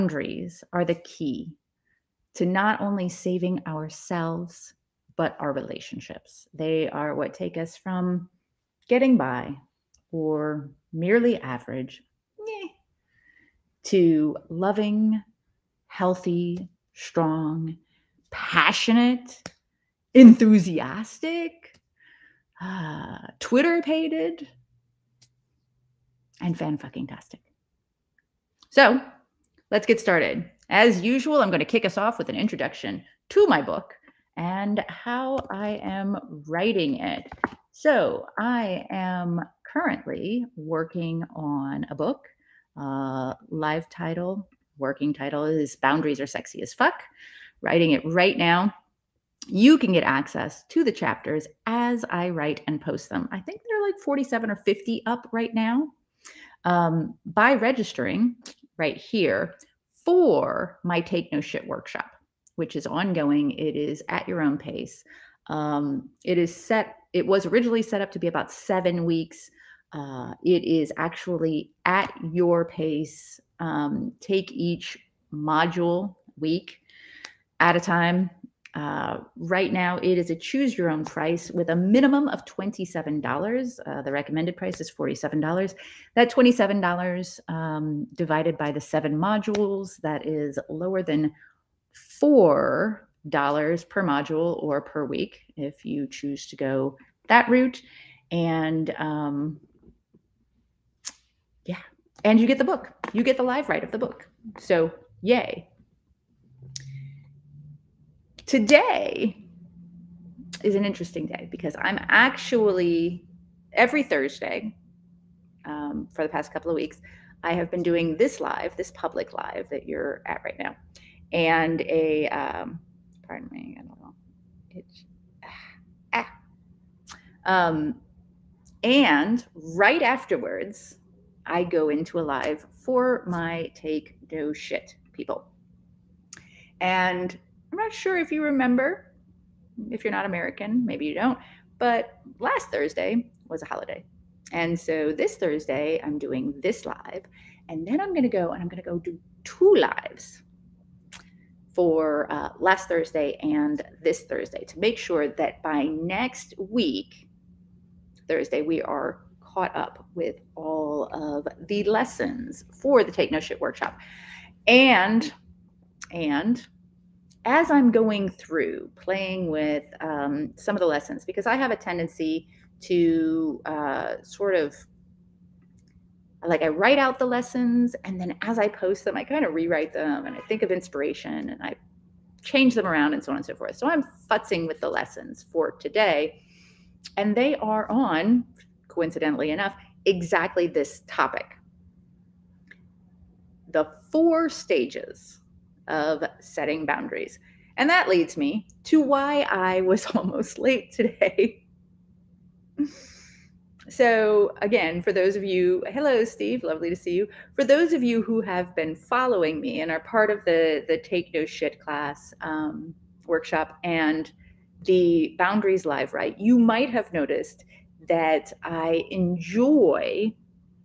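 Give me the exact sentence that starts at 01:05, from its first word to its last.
Um, it is set, it was originally set up to be about seven weeks.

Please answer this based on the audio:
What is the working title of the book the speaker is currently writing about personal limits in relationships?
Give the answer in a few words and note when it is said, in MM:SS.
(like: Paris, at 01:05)
Boundaries Are Sexy as Fuck, at 00:45.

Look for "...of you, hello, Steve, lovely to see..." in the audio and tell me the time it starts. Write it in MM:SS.
03:25.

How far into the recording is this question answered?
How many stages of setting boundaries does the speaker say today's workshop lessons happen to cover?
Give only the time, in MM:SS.
03:14.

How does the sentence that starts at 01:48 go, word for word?
Today is an interesting day because I'm actually every Thursday um, for the past couple of weeks.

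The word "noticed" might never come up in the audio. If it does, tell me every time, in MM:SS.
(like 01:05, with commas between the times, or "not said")
03:37.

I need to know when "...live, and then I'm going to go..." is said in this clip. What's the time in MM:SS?
02:26.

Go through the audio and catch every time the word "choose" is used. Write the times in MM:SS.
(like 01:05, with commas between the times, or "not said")
01:20, 01:36.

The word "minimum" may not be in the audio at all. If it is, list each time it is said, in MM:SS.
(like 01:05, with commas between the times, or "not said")
01:21.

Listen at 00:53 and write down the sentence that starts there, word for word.
I think they're like 47 or 50 up right now.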